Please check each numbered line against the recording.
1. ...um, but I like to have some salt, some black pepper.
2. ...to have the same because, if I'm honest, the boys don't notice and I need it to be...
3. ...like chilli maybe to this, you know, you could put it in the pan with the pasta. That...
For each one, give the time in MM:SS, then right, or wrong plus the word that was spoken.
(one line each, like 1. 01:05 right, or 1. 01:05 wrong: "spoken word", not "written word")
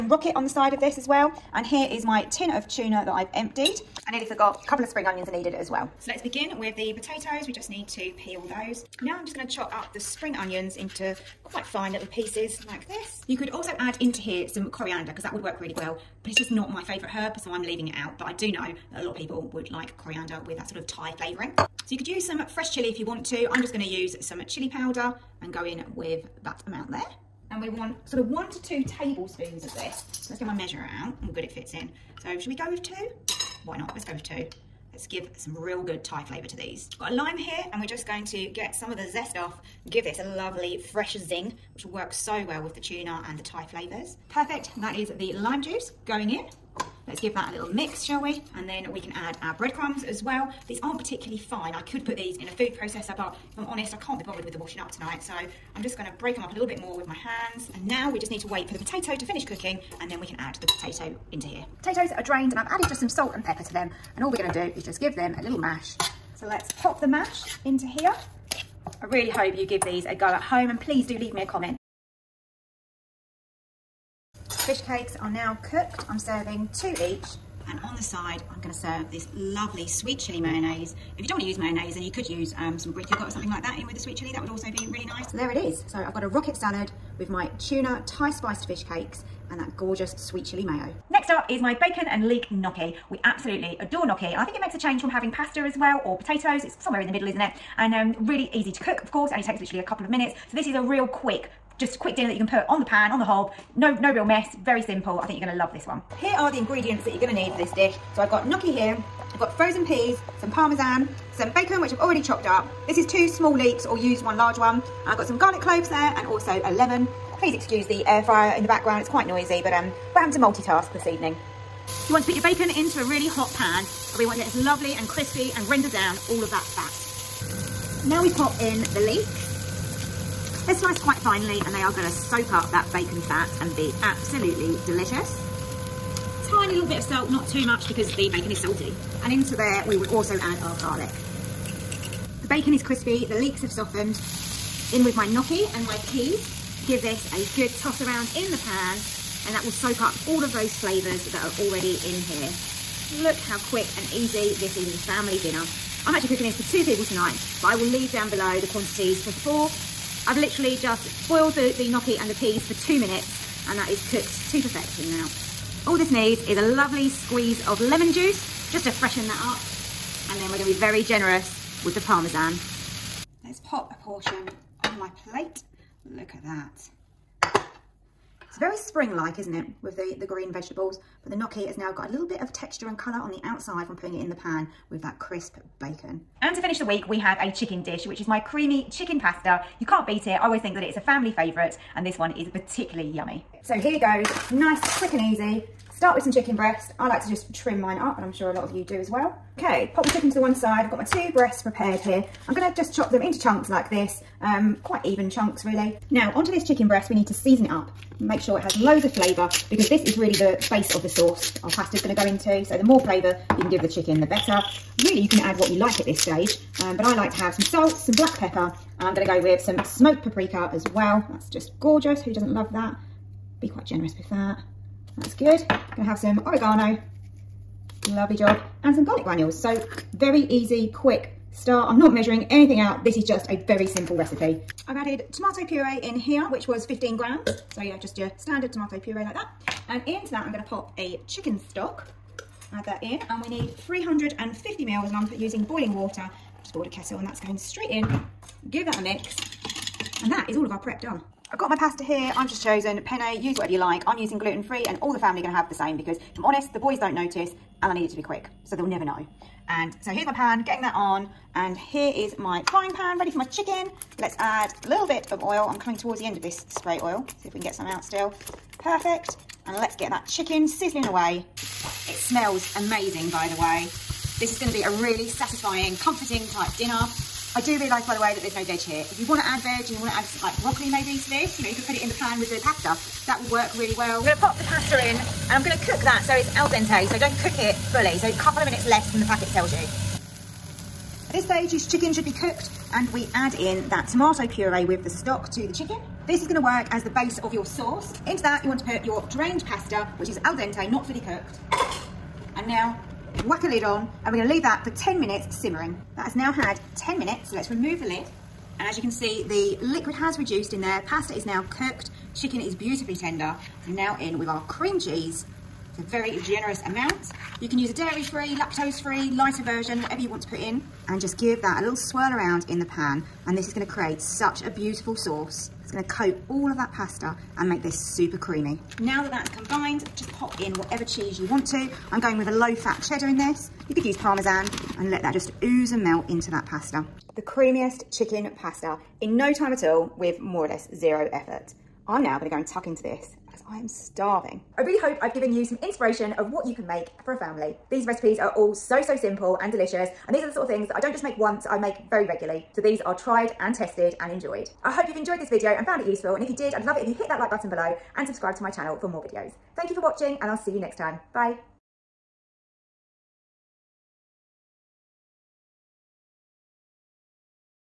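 1. 03:36 right
2. 04:15 right
3. 04:40 wrong: "broccoli", not "chilli".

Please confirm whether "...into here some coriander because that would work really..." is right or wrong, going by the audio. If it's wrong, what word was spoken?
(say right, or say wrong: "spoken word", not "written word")
right.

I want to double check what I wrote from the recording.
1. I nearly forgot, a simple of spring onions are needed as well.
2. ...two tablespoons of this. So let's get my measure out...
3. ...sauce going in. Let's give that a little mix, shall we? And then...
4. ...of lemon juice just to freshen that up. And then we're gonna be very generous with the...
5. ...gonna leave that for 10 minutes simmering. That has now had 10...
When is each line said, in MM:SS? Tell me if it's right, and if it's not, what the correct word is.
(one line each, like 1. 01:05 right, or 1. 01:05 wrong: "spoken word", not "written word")
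1. 00:04 wrong: "couple", not "simple"
2. 00:28 right
3. 00:45 wrong: "juice", not "sauce"
4. 02:47 right
5. 05:04 right.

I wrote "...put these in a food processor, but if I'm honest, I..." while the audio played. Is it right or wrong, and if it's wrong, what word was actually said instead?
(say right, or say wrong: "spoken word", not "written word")
right.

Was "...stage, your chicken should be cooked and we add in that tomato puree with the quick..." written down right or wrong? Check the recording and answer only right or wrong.
wrong.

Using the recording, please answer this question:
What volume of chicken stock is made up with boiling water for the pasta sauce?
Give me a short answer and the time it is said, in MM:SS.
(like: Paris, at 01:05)
350 ml, at 04:03.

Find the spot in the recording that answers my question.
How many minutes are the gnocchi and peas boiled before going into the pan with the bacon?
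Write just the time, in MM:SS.
02:42.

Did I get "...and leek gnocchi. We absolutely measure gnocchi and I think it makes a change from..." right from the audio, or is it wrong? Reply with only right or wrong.
wrong.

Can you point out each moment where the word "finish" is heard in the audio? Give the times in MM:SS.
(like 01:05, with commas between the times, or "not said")
00:59, 03:06.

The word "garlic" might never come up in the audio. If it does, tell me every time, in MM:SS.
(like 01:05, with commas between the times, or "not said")
01:55, 02:20, 03:49.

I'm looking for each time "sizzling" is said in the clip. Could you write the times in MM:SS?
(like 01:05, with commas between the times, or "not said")
04:30.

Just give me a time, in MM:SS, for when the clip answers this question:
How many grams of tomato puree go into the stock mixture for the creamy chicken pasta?
03:56.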